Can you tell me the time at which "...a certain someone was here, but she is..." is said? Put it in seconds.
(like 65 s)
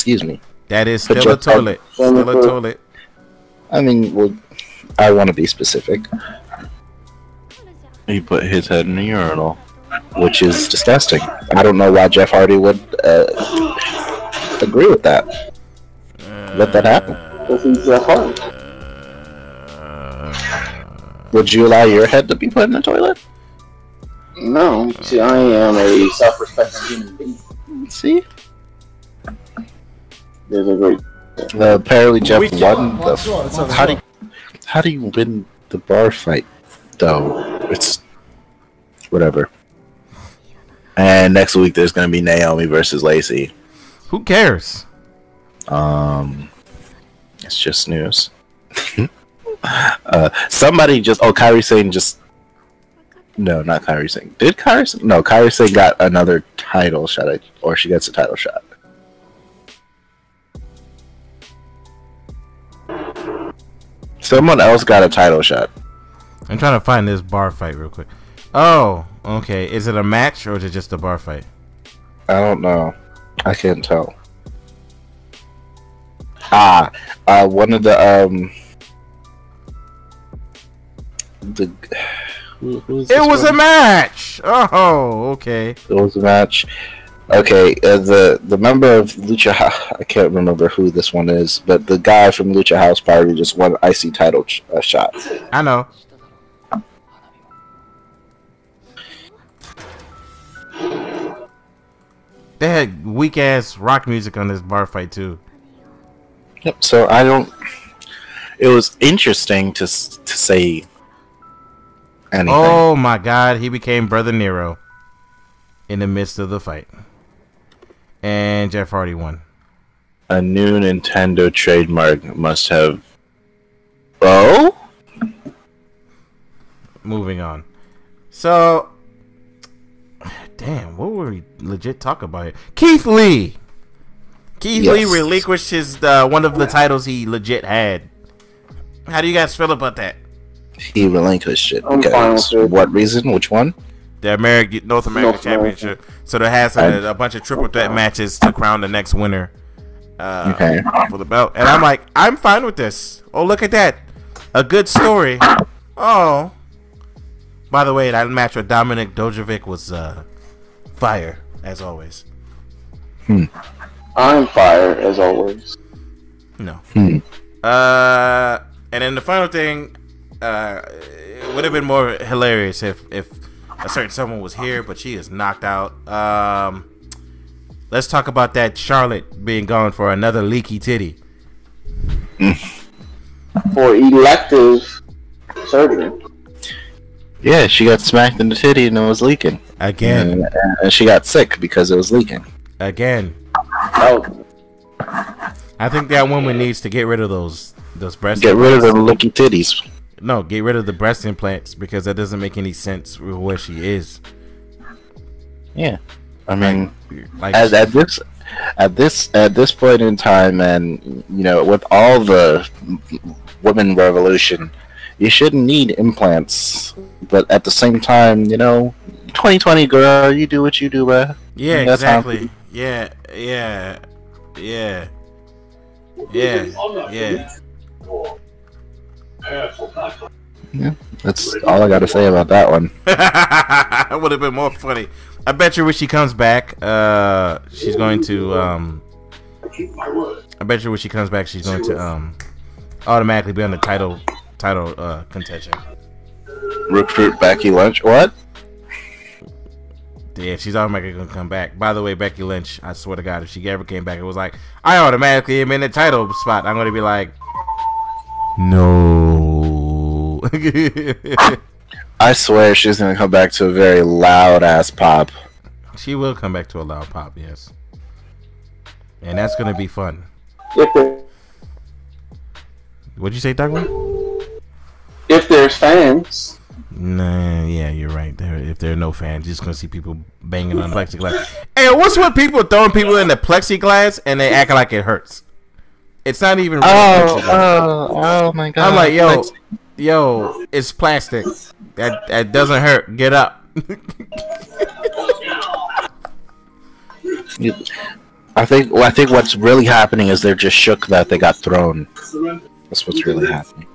173 s.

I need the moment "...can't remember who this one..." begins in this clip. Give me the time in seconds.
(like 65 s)
90 s.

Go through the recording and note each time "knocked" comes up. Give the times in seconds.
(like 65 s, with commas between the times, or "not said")
175 s.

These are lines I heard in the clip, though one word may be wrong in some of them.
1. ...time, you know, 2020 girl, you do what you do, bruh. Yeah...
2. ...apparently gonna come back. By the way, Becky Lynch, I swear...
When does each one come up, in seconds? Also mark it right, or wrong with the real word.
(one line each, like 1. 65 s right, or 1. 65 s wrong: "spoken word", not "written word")
1. 218 s right
2. 250 s wrong: "automatically", not "apparently".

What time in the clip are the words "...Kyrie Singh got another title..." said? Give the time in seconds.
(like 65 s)
55 s.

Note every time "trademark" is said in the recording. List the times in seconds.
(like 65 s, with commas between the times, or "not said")
121 s.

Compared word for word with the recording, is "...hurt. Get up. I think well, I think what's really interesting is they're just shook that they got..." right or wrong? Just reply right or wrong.
wrong.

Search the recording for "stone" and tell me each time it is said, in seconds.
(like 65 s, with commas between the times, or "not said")
not said.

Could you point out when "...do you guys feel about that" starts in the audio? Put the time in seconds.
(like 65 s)
139 s.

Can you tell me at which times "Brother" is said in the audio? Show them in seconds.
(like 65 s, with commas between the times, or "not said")
114 s.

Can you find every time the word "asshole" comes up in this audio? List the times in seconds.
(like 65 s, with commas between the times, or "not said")
not said.